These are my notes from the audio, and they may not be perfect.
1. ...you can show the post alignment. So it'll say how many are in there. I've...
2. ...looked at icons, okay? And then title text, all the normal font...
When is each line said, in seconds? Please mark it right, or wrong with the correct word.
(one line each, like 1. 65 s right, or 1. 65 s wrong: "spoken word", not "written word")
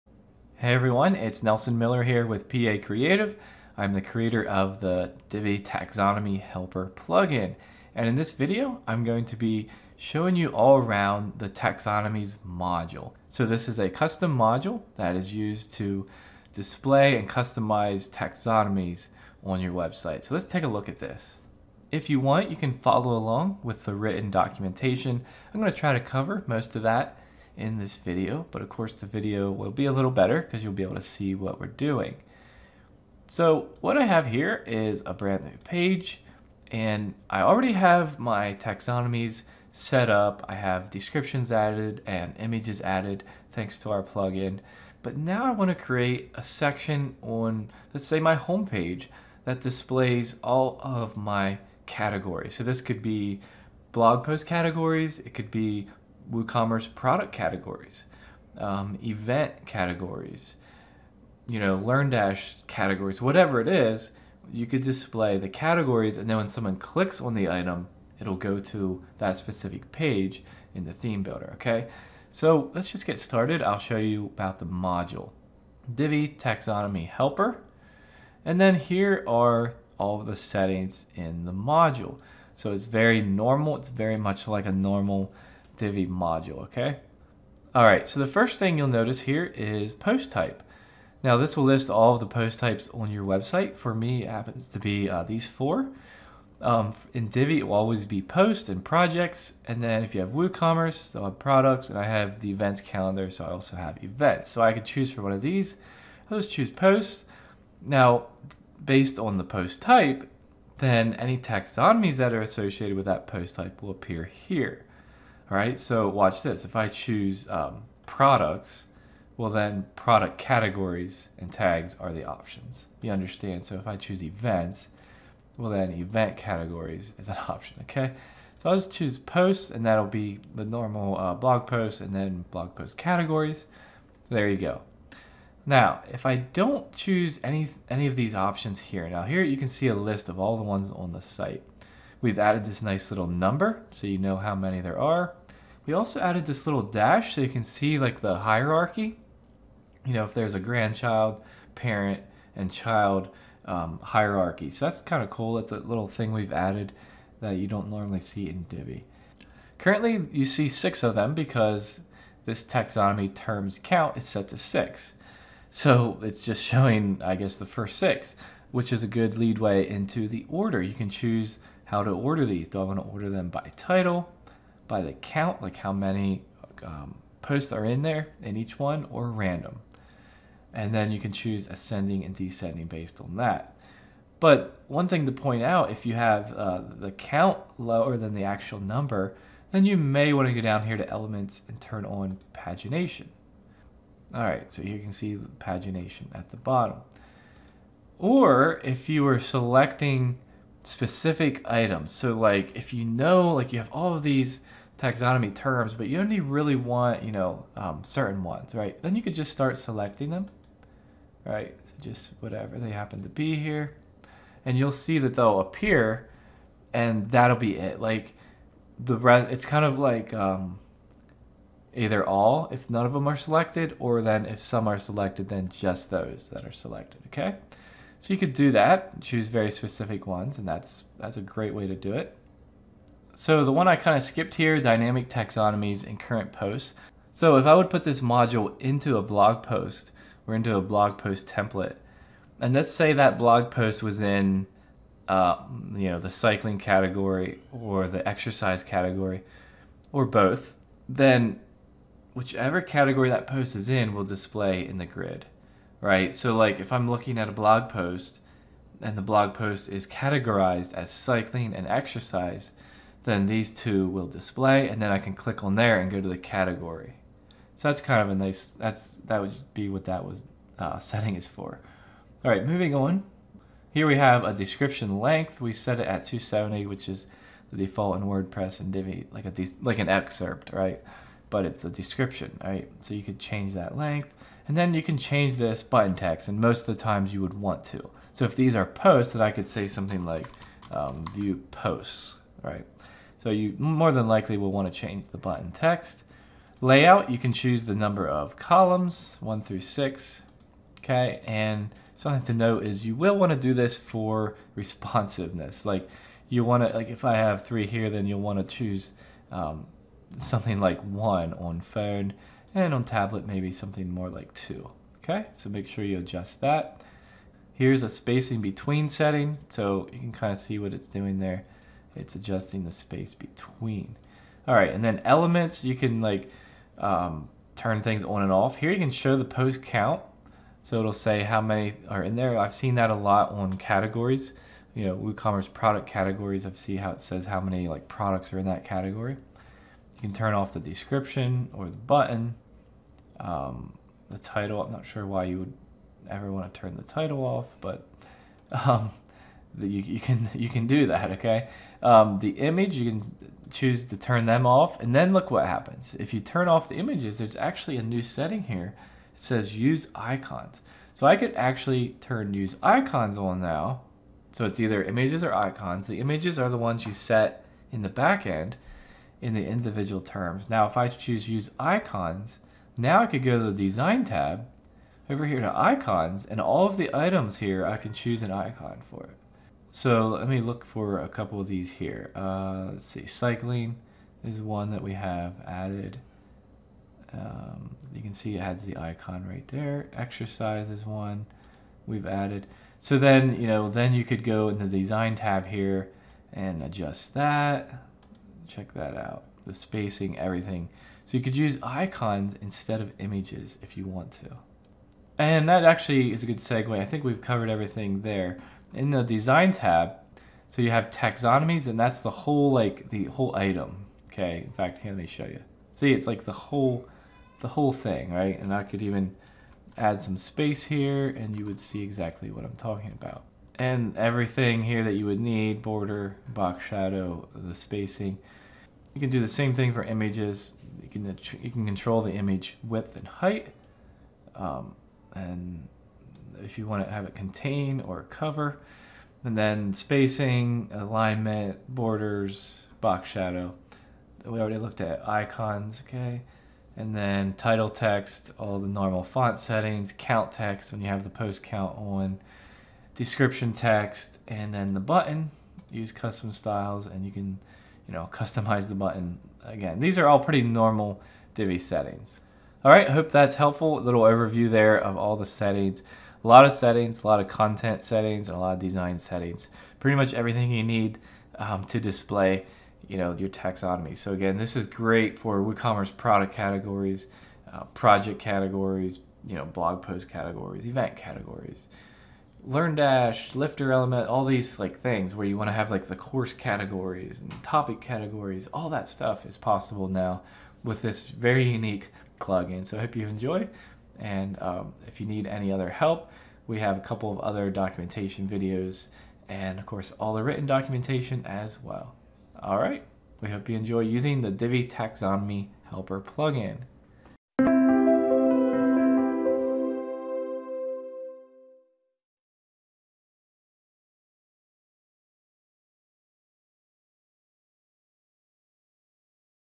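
1. 328 s wrong: "count", not "alignment"
2. 444 s right.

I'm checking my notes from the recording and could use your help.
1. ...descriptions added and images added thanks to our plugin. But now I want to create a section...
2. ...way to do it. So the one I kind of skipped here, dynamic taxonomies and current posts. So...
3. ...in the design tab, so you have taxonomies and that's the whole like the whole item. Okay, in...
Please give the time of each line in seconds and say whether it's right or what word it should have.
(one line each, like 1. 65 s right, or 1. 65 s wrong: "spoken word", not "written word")
1. 40 s right
2. 231 s right
3. 408 s right.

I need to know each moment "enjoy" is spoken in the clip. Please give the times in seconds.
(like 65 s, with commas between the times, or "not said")
493 s, 503 s.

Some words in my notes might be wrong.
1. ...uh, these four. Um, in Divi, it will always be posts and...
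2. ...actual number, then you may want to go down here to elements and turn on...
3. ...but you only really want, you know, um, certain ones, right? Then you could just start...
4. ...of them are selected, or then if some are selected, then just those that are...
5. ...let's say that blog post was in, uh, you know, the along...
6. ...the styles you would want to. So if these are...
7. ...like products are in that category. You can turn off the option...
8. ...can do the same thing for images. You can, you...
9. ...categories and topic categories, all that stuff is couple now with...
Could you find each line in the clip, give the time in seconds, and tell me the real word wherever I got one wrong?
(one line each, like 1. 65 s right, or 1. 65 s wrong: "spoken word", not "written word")
1. 95 s right
2. 188 s right
3. 205 s right
4. 223 s right
5. 242 s wrong: "cycling", not "along"
6. 286 s wrong: "times", not "styles"
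7. 337 s wrong: "description", not "option"
8. 429 s right
9. 486 s wrong: "possible", not "couple".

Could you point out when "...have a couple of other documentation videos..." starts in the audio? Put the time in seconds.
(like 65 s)
496 s.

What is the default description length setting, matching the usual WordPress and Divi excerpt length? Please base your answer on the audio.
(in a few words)
270.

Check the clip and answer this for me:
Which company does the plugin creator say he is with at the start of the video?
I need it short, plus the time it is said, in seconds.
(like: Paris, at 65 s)
Pee-Aye Creative, at 2 s.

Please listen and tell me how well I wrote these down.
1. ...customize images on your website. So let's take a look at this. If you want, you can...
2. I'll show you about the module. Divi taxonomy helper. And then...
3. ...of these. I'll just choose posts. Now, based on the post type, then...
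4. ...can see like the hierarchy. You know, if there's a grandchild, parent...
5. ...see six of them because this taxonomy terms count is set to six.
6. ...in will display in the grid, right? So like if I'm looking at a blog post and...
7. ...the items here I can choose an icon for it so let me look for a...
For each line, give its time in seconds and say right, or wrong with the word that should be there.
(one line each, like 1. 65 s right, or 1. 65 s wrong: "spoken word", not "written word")
1. 17 s wrong: "taxonomies", not "images"
2. 73 s right
3. 105 s right
4. 147 s right
5. 160 s right
6. 253 s right
7. 376 s right.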